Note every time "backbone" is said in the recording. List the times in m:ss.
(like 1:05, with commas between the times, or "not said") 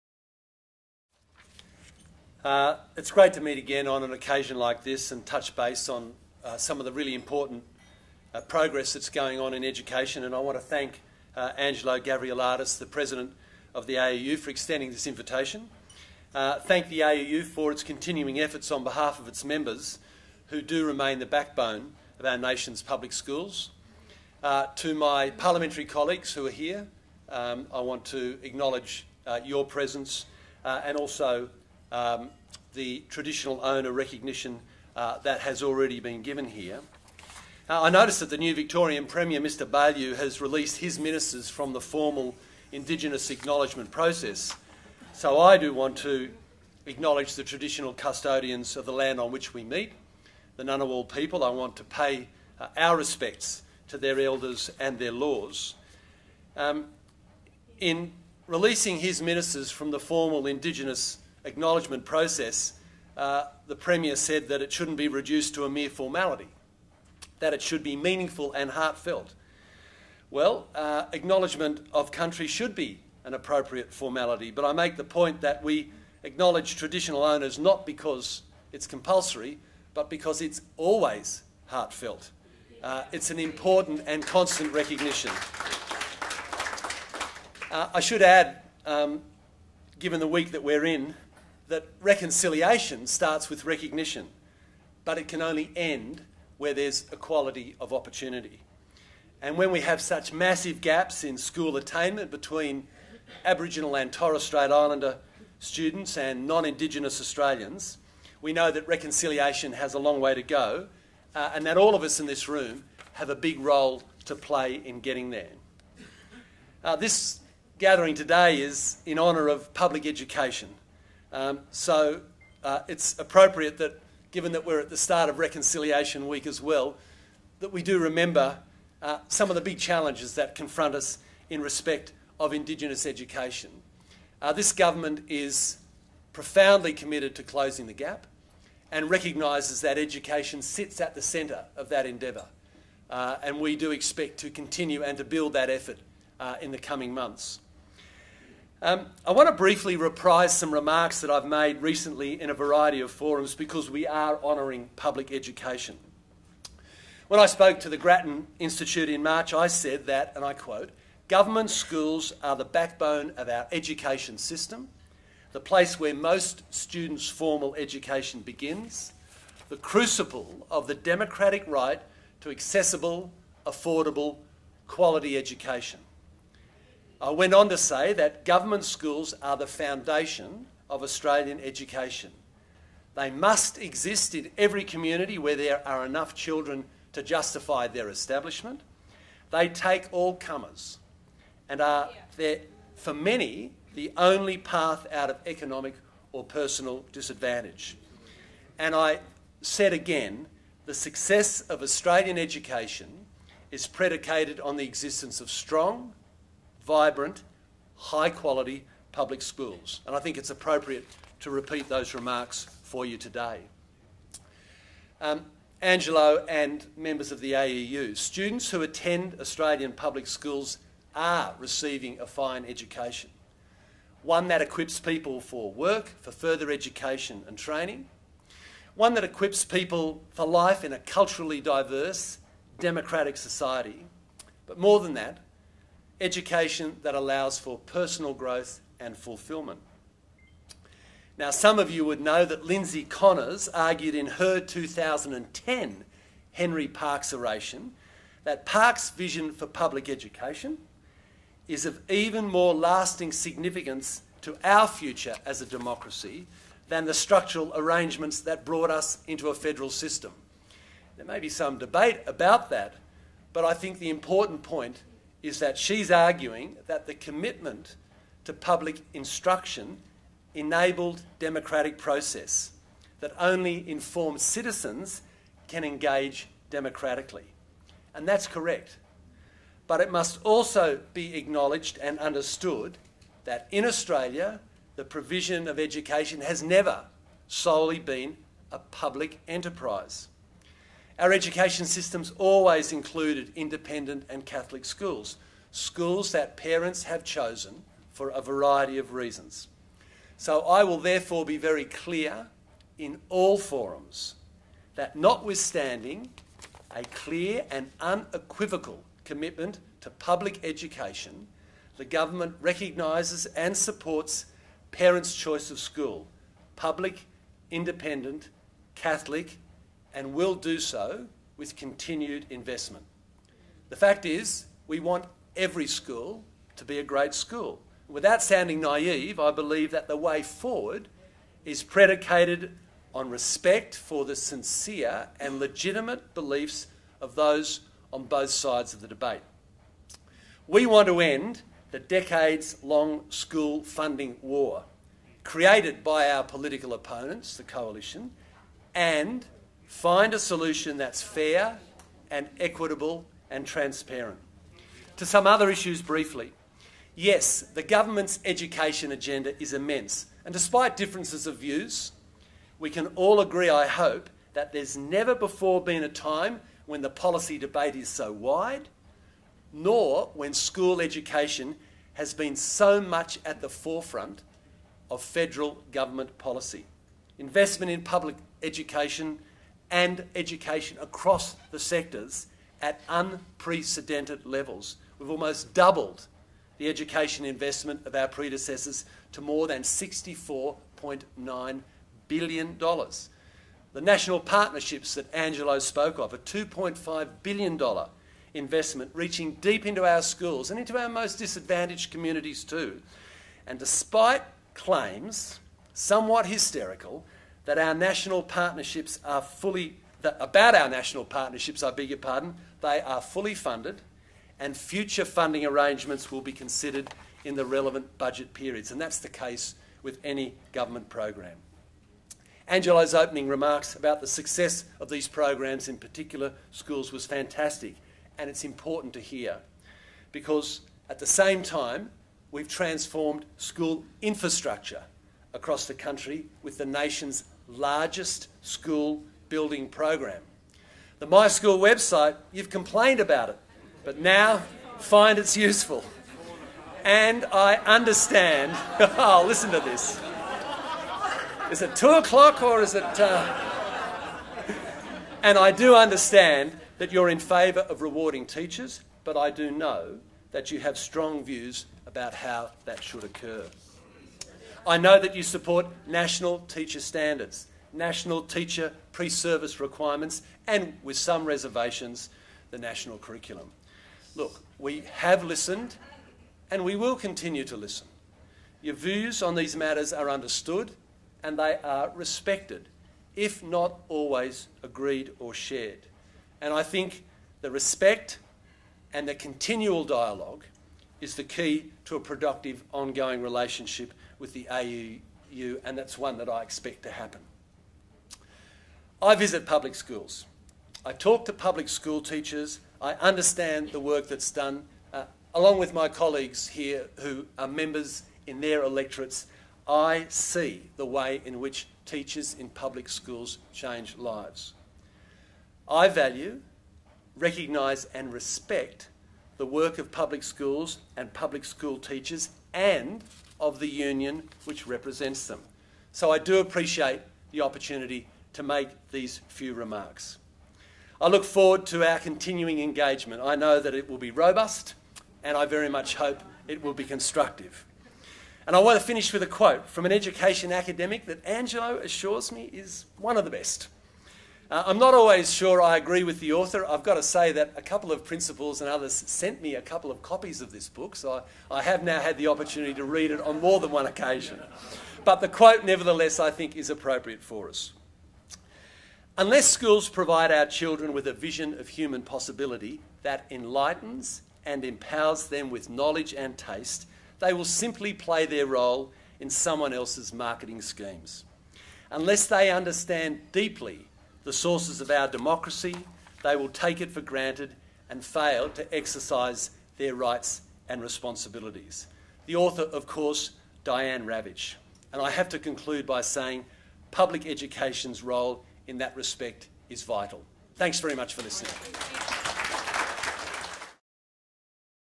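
0:21, 2:42.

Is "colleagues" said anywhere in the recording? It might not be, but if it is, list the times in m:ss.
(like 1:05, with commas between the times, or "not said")
0:25, 8:26.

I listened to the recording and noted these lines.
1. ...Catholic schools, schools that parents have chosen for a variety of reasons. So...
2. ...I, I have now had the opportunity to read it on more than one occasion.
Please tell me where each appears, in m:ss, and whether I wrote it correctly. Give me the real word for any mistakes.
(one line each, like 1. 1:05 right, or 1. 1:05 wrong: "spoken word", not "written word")
1. 4:54 right
2. 9:11 right.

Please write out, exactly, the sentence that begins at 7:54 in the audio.
Look, we have listened and we will continue to listen.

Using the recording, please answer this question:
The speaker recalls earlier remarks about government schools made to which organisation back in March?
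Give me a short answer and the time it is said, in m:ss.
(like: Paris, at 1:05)
Grattan Institute, at 2:37.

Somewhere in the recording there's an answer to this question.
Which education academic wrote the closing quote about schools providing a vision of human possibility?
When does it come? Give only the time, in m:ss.
9:43.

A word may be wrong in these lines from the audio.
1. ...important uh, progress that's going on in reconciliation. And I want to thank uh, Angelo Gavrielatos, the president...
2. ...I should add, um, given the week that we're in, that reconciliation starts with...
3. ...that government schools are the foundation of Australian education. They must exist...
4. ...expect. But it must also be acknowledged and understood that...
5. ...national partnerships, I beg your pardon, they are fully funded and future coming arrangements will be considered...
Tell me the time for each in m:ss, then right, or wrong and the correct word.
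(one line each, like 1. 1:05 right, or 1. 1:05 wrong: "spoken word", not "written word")
1. 0:07 wrong: "education", not "reconciliation"
2. 1:27 right
3. 2:58 right
4. 4:38 wrong: "correct", not "expect"
5. 6:50 wrong: "funding", not "coming".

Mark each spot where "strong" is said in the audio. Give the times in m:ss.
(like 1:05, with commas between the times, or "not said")
3:25, 7:40.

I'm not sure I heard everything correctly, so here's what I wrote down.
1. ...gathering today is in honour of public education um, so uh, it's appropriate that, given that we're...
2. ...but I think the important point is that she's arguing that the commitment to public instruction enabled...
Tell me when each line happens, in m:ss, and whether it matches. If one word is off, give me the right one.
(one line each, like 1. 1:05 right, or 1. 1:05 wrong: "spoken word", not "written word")
1. 1:57 right
2. 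4:23 right.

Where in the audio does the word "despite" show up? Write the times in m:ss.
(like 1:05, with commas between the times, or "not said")
6:00, 6:43.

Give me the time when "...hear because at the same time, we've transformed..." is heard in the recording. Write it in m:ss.
7:09.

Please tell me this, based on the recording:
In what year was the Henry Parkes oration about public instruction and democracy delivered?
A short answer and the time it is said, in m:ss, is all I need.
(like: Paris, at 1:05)
2010, at 4:04.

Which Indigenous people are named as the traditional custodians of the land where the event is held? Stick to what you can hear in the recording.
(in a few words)
Ngunnawal.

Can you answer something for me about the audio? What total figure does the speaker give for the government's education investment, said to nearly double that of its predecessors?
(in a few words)
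$64.9 billion.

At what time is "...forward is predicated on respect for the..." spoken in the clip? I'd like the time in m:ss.
5:30.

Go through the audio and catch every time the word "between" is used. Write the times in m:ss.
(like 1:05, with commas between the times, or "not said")
1:42.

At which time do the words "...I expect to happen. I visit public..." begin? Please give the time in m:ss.
8:16.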